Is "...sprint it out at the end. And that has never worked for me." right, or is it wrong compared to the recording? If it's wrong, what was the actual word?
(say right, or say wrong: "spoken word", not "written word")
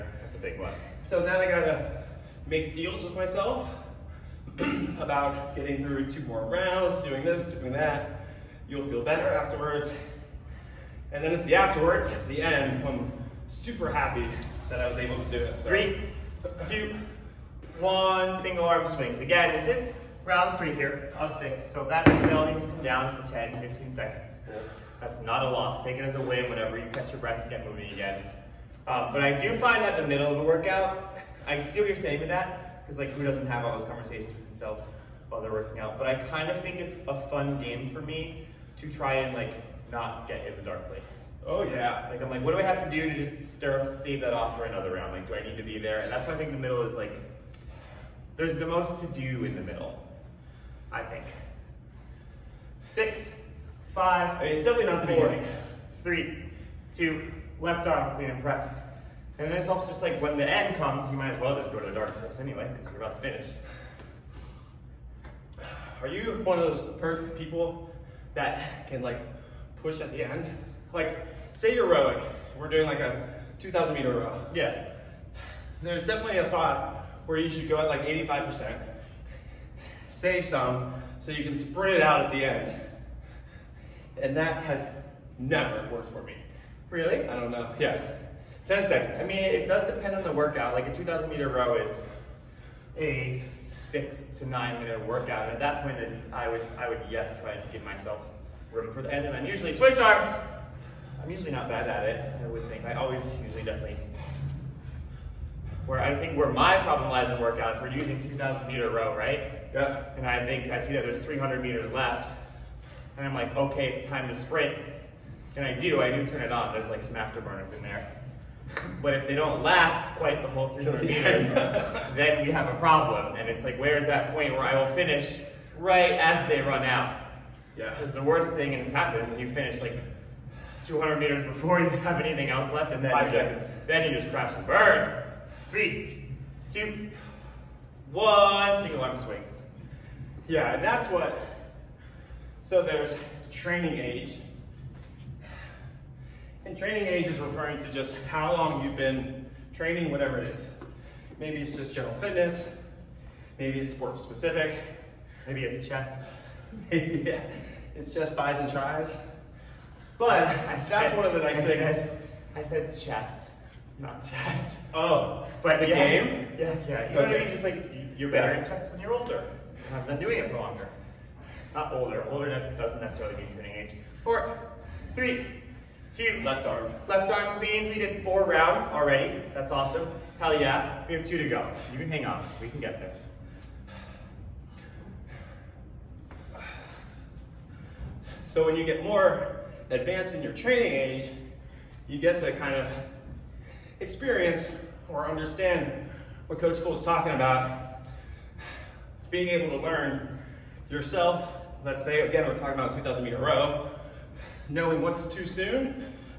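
right.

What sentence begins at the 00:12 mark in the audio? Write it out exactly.
I'm super happy that I was able to do it.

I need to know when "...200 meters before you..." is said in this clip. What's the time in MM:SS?
02:10.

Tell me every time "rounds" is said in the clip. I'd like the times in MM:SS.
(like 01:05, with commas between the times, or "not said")
00:06, 00:20, 00:44, 02:58.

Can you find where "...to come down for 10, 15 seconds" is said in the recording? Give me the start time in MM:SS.
00:22.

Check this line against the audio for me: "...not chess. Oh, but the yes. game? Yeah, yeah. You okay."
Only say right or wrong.
right.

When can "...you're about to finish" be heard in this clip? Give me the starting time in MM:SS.
01:02.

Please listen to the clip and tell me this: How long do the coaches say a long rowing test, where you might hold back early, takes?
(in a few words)
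6 to 9 minutes.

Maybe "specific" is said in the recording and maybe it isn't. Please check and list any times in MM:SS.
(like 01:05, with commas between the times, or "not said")
02:34.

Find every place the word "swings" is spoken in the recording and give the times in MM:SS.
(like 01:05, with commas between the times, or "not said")
00:18, 02:19.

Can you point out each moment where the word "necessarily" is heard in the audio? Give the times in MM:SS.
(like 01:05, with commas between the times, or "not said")
02:53.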